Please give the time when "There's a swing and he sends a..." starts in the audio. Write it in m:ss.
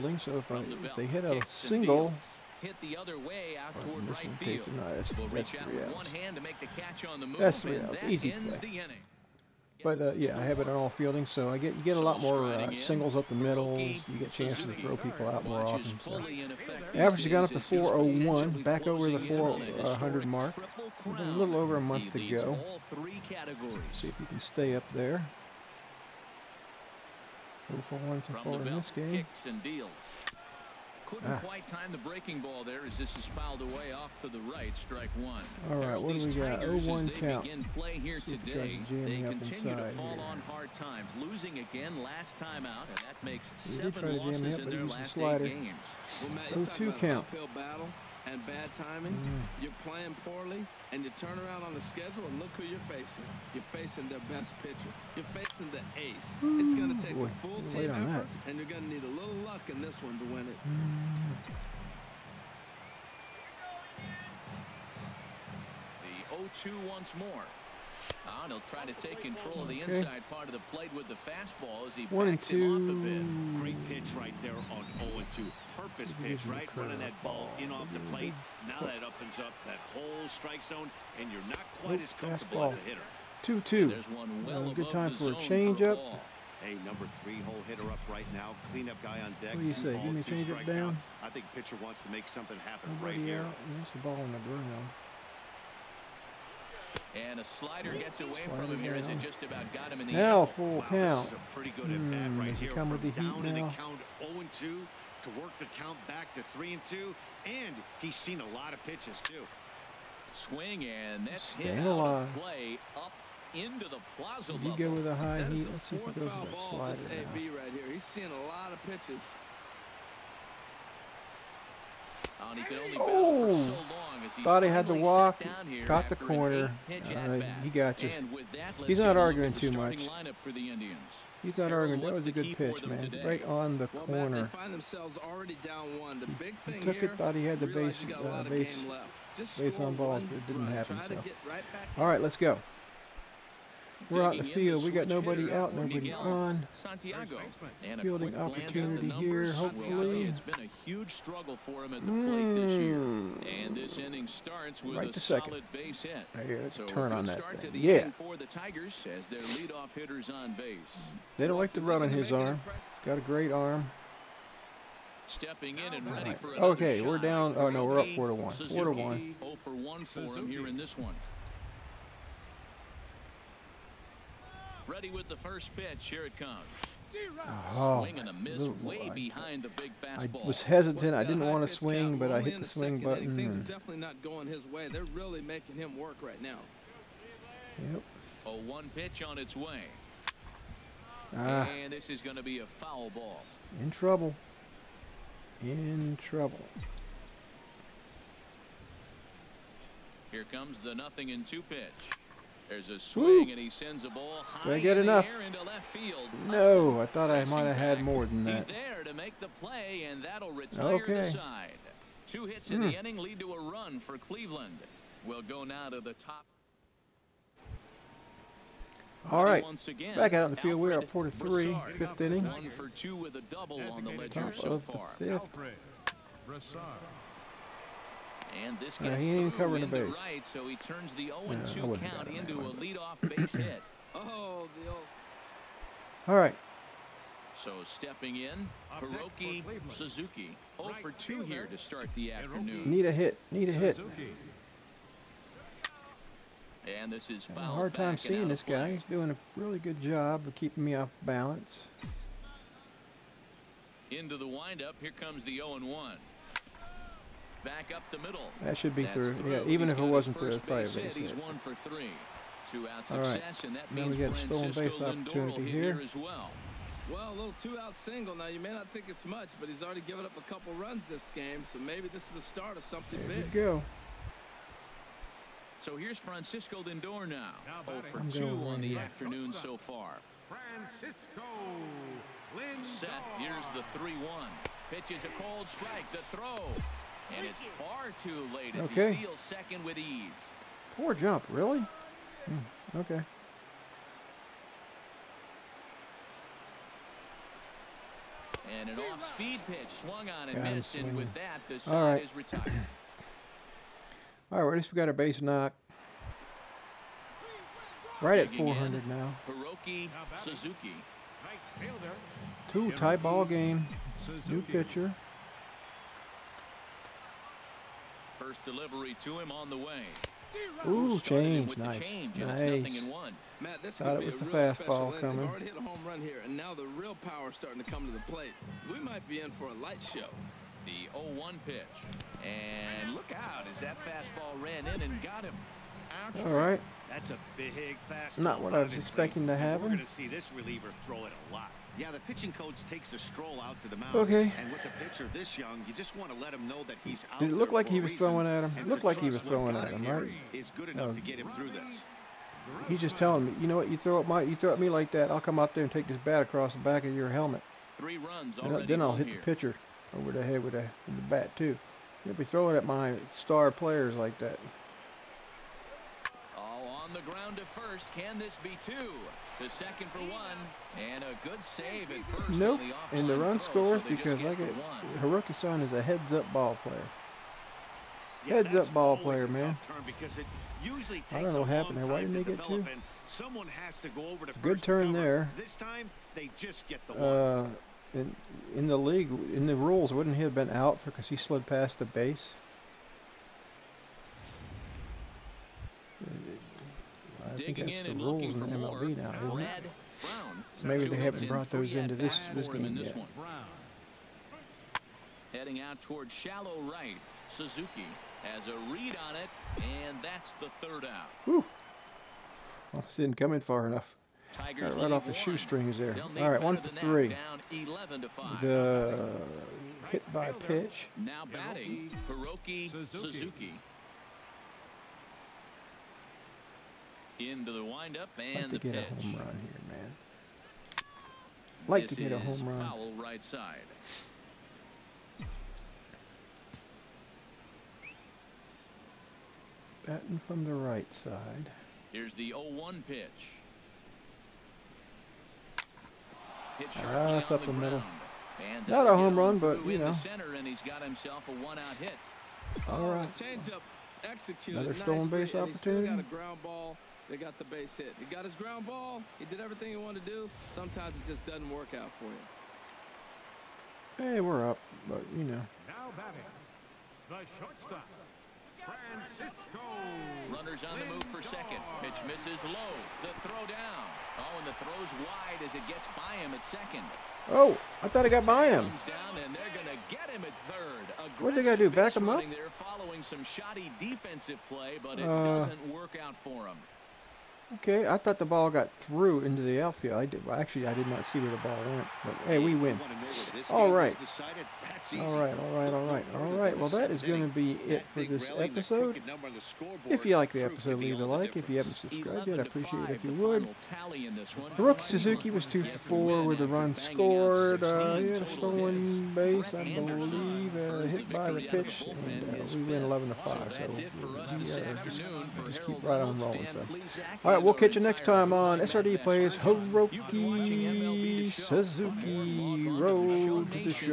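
3:22.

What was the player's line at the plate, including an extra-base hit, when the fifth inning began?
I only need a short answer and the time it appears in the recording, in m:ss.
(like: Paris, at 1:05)
One for two with a double, at 3:42.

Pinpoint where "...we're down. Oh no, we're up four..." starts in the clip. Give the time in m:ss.
2:47.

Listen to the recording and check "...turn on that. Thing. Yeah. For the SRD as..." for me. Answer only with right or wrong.
wrong.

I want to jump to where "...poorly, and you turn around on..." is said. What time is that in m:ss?
0:50.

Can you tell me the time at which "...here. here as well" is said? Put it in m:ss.
4:25.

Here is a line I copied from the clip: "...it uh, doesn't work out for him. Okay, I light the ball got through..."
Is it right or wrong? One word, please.
wrong.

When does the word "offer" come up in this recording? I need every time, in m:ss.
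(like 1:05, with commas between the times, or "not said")
not said.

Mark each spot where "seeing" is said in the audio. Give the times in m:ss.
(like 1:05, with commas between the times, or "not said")
1:58, 4:08.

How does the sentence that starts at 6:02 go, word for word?
You'll be throwing at my star players like that.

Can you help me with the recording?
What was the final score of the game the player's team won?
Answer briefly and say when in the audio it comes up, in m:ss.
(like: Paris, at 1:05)
11 to 5, at 8:33.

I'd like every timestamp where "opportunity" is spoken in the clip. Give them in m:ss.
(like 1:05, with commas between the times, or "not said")
2:28, 4:24, 7:35.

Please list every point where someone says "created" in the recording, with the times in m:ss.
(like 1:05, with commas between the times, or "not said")
not said.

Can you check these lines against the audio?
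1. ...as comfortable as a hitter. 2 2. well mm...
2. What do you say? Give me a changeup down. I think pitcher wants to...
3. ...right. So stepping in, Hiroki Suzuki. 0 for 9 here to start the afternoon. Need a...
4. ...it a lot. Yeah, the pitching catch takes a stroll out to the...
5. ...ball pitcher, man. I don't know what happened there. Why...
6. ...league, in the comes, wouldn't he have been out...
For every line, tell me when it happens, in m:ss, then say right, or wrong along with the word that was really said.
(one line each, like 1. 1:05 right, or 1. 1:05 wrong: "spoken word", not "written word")
1. 1:22 right
2. 1:29 right
3. 3:56 wrong: "2", not "9"
4. 5:41 wrong: "coach", not "catch"
5. 6:18 wrong: "player", not "pitcher"
6. 6:28 wrong: "rules", not "comes".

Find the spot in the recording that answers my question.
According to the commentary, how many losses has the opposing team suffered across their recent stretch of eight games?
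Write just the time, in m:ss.
0:43.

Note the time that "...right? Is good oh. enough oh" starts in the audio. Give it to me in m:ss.
5:50.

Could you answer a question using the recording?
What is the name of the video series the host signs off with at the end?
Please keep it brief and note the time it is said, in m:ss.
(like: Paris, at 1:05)
SRD Plays Hiroki Suzuki, at 8:38.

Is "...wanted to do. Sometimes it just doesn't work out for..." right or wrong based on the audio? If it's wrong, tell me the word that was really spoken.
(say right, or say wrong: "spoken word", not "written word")
right.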